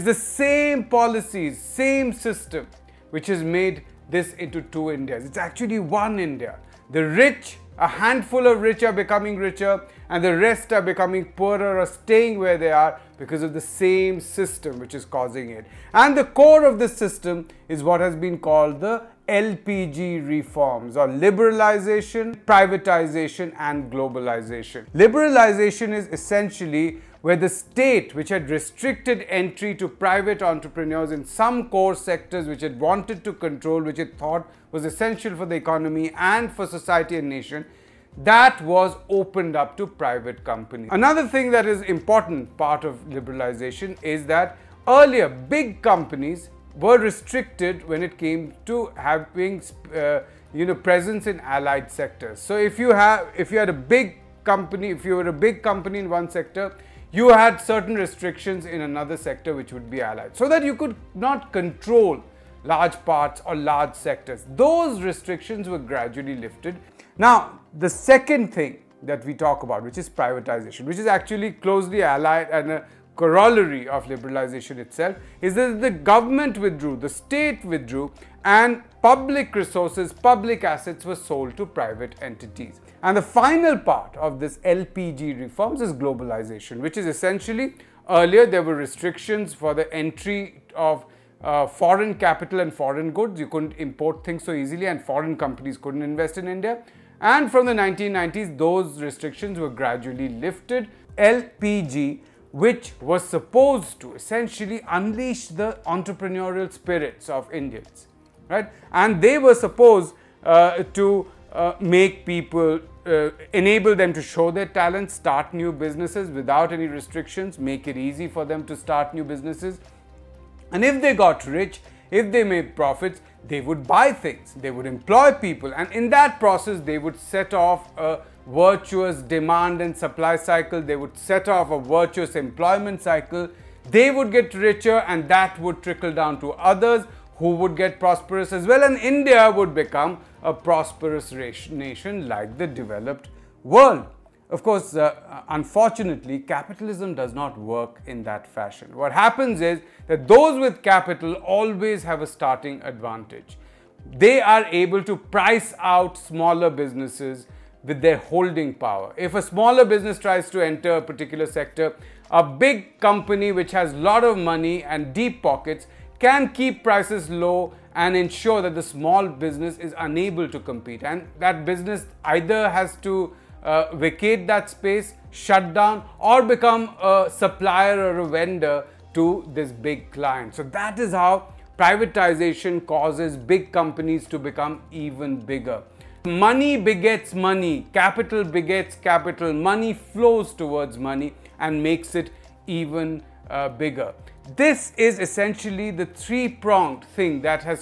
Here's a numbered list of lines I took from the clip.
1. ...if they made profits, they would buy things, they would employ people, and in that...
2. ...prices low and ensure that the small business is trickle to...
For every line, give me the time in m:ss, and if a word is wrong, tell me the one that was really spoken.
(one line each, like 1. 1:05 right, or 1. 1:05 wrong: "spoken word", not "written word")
1. 2:02 right
2. 2:46 wrong: "unable", not "trickle".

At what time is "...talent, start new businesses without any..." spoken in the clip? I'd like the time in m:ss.
1:54.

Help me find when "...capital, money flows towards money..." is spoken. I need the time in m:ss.
3:08.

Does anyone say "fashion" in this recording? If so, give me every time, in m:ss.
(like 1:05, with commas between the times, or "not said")
2:28.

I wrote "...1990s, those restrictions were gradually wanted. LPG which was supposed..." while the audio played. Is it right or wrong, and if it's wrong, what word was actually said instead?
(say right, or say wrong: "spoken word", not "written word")
wrong: "lifted", not "wanted".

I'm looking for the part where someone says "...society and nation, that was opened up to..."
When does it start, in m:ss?
0:36.